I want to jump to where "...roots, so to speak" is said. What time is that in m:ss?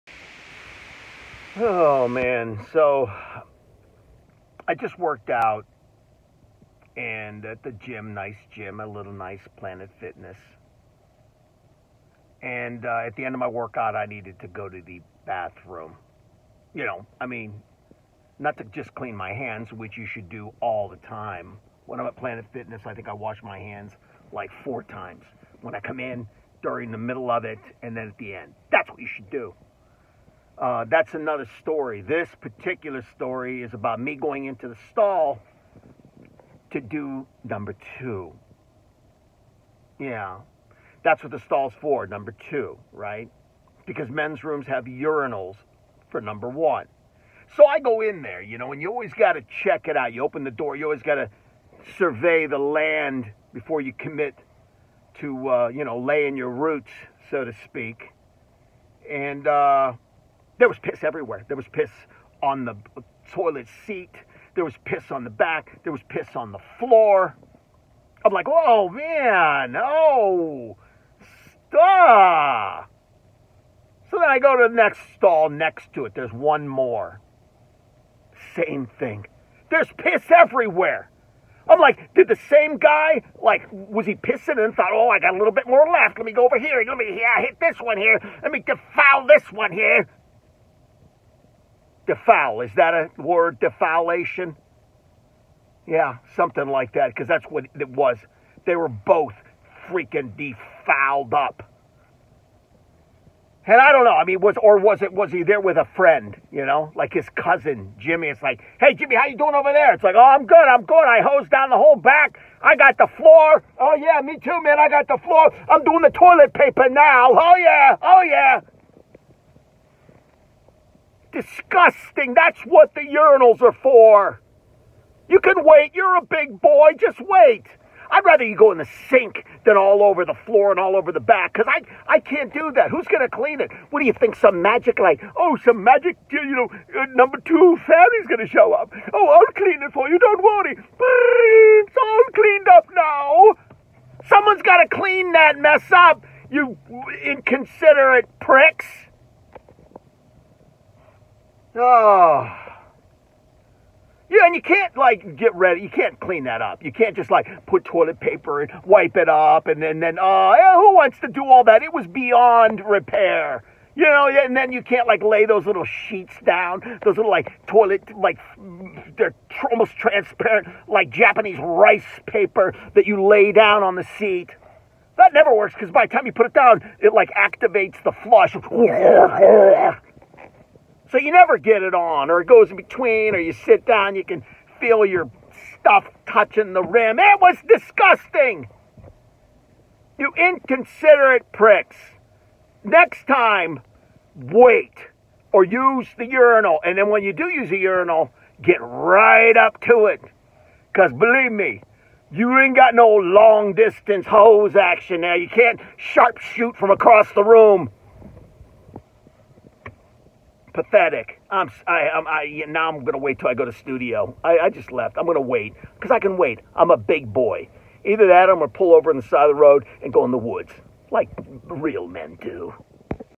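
0:56.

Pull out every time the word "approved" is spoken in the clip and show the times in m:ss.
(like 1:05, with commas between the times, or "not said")
not said.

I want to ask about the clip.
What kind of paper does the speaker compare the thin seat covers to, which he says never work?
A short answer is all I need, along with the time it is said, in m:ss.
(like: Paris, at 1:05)
Japanese rice paper, at 2:51.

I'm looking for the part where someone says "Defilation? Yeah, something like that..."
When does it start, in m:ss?
1:33.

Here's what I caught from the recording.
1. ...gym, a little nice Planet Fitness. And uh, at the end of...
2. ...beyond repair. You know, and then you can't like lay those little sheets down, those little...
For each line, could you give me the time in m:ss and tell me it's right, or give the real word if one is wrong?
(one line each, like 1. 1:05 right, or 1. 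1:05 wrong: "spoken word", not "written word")
1. 0:08 right
2. 2:42 right.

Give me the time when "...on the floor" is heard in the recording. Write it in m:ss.
1:06.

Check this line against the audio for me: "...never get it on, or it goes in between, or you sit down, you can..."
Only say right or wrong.
right.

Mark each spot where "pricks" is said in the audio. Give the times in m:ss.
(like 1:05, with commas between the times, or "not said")
2:28, 3:11.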